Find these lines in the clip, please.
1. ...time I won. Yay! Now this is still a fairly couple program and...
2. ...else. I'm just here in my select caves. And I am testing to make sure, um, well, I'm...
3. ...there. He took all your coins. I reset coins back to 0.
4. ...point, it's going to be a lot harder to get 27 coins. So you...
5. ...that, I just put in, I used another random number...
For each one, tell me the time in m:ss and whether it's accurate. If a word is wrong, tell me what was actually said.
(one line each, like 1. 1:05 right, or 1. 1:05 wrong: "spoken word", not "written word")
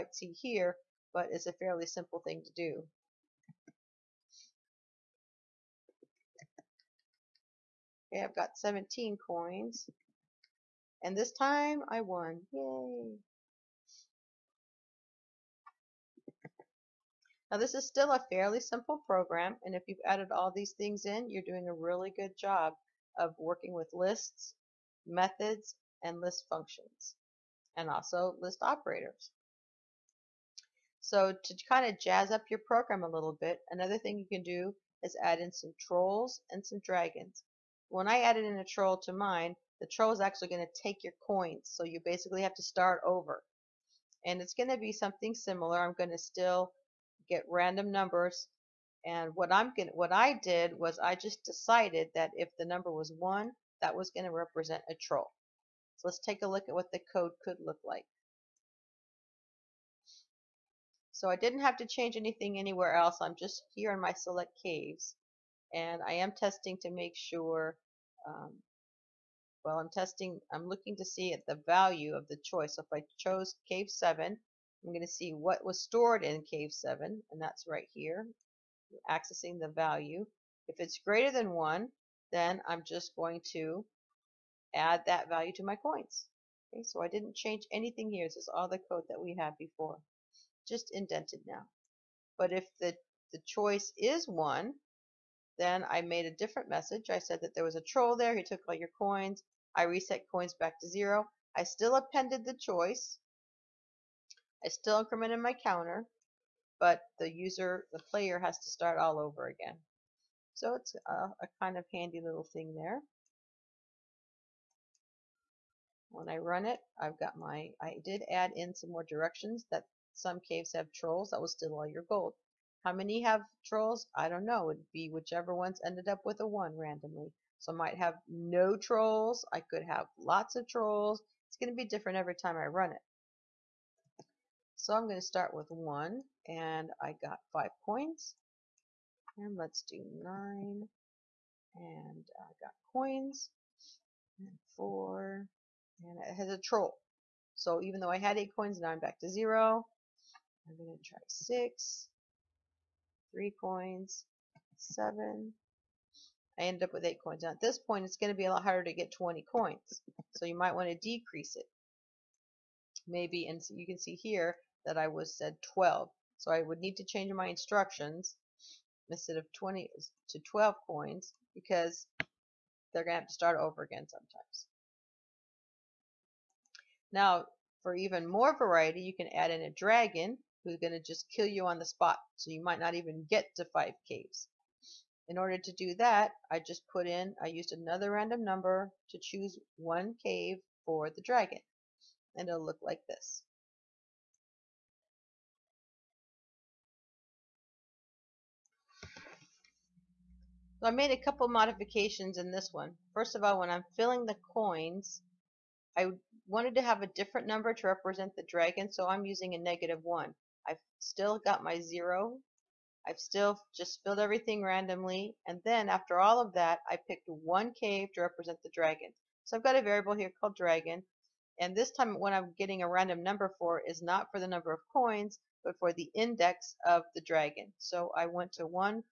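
1. 0:11 wrong: "simple", not "couple"
2. 1:02 right
3. 1:38 right
4. 2:37 wrong: "20", not "27"
5. 3:05 right.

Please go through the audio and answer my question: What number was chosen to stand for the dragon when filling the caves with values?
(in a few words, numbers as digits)
-1.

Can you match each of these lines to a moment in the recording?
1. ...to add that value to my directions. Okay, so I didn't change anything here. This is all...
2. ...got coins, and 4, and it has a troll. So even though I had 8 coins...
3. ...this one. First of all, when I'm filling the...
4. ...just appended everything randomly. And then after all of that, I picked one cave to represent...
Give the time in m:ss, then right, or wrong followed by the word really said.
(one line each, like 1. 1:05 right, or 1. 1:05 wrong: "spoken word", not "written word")
1. 1:23 wrong: "coins", not "directions"
2. 2:22 right
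3. 3:22 right
4. 3:33 wrong: "filled", not "appended".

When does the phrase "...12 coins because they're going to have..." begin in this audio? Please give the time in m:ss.
2:50.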